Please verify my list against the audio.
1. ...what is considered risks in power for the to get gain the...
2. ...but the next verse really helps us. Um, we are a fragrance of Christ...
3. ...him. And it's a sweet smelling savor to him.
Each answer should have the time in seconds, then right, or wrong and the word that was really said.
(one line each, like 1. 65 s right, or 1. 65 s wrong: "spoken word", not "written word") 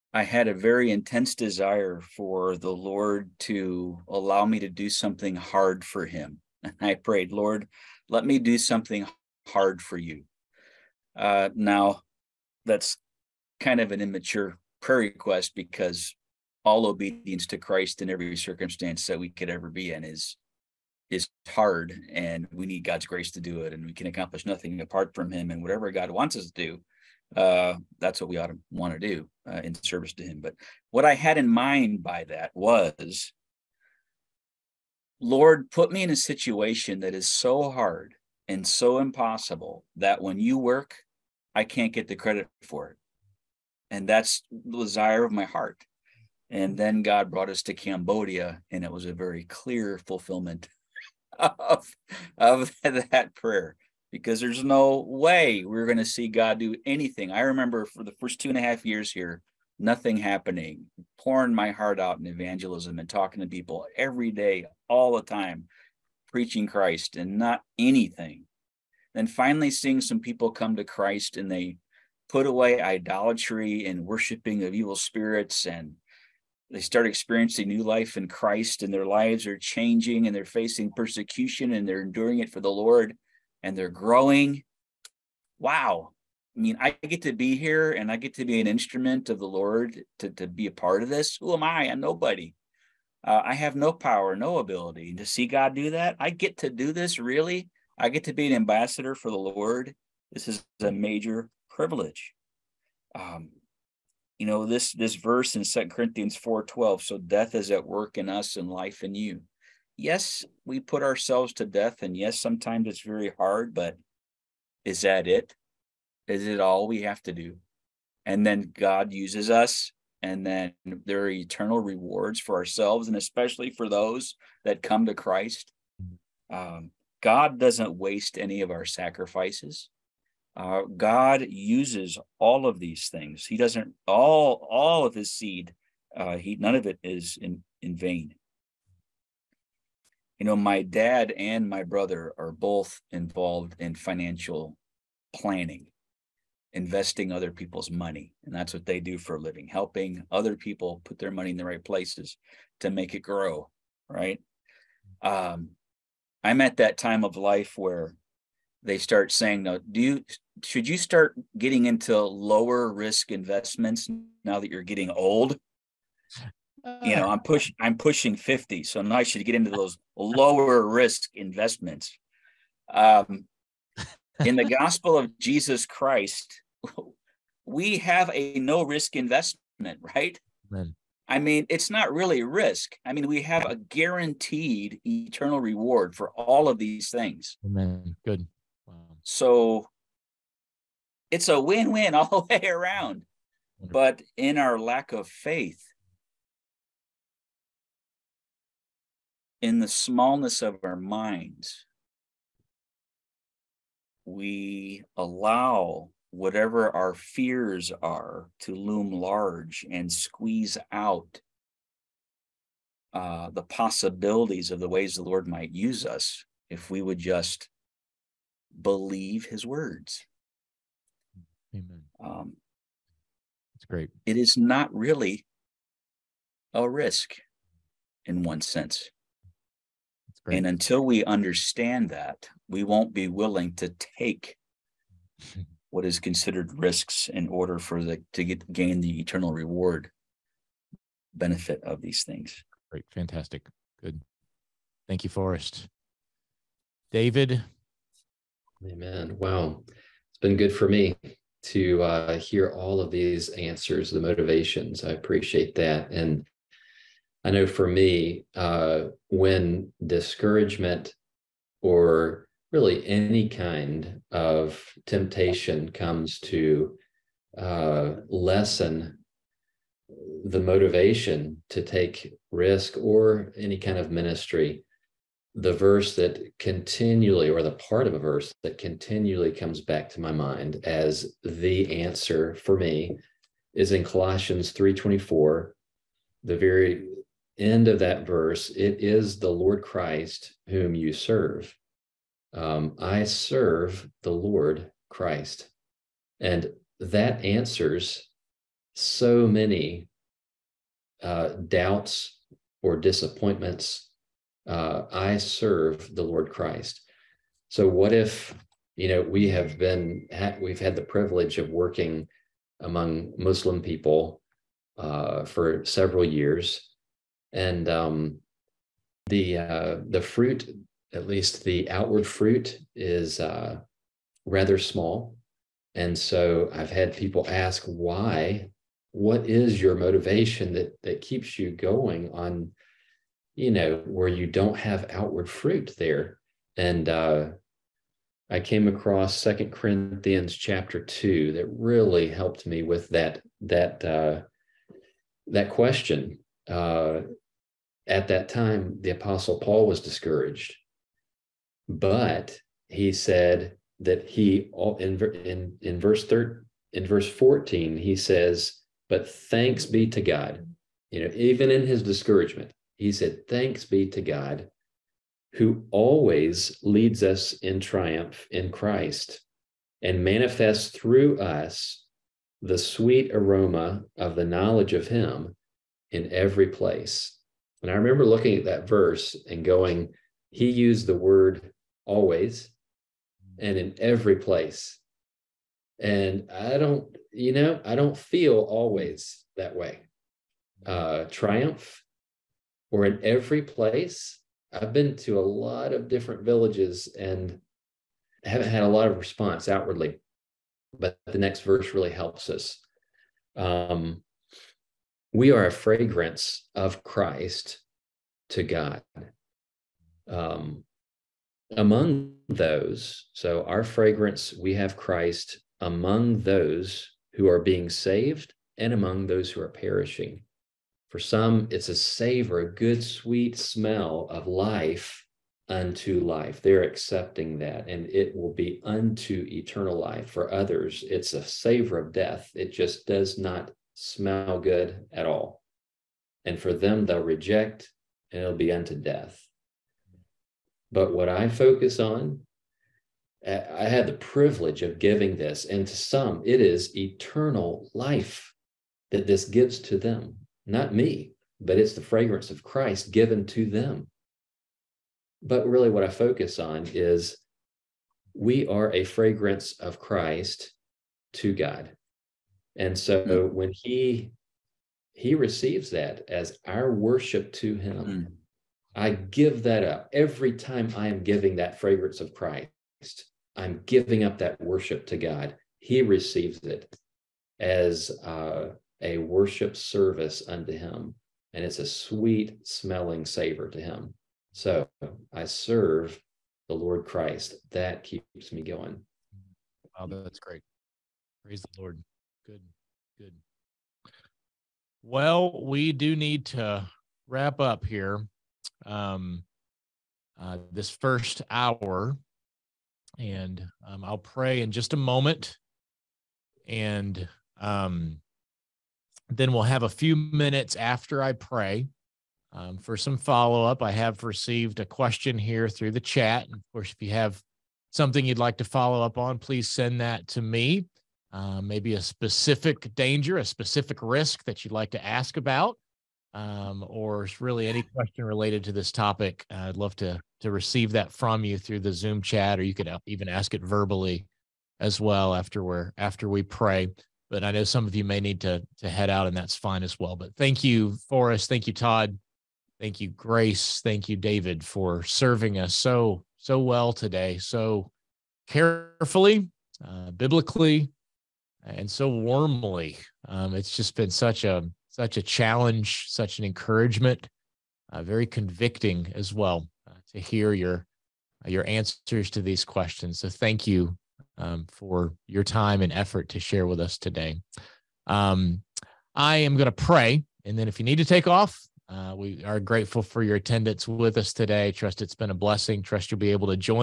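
1. 235 s wrong: "order", not "power"
2. 400 s right
3. 480 s right.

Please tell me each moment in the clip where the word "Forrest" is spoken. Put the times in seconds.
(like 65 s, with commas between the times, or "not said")
245 s, 541 s.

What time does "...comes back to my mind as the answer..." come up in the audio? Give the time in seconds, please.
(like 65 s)
279 s.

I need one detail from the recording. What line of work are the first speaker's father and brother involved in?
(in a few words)
financial planning.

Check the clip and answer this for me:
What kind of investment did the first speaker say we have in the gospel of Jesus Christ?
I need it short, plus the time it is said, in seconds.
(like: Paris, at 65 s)
no risk investment, at 178 s.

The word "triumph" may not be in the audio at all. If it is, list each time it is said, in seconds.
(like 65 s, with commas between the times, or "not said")
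367 s, 391 s.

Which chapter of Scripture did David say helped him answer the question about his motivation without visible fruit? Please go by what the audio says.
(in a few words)
2 Corinthians 2.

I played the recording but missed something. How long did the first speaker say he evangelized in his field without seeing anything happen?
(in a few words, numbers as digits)
two and a half years.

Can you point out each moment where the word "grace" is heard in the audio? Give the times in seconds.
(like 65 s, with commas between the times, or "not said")
23 s, 543 s.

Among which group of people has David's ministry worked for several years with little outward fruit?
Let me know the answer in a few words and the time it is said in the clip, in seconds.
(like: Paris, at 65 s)
Muslim people, at 313 s.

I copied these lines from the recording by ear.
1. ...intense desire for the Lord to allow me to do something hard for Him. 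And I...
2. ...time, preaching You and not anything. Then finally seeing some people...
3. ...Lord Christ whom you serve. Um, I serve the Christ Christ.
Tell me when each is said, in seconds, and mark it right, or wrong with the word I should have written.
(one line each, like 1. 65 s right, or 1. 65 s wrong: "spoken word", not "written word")
1. 0 s right
2. 65 s wrong: "Christ", not "You"
3. 289 s wrong: "Lord", not "Christ".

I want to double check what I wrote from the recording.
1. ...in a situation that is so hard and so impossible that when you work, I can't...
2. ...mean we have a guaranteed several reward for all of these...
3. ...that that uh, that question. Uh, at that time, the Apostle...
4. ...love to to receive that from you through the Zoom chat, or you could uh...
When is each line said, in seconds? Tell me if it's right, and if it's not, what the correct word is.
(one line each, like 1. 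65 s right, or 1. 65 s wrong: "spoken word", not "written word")
1. 36 s right
2. 183 s wrong: "eternal", not "several"
3. 343 s right
4. 529 s right.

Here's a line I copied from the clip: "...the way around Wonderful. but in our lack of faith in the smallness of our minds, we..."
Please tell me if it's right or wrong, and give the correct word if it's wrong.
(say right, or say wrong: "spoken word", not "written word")
right.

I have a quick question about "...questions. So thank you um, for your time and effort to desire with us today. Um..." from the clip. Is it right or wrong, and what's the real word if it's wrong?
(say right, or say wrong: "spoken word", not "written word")
wrong: "share", not "desire".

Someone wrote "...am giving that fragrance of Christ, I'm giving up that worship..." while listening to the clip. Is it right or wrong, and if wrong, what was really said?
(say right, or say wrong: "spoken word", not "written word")
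right.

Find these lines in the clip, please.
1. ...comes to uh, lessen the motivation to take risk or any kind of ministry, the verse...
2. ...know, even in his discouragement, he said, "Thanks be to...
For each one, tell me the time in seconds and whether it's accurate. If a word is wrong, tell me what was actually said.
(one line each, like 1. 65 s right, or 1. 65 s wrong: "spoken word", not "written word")
1. 265 s right
2. 361 s right.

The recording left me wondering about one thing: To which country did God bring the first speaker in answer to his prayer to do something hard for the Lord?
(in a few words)
Cambodia.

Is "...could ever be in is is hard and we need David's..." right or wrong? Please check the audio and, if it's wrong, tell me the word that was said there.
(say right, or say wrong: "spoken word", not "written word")
wrong: "God", not "David".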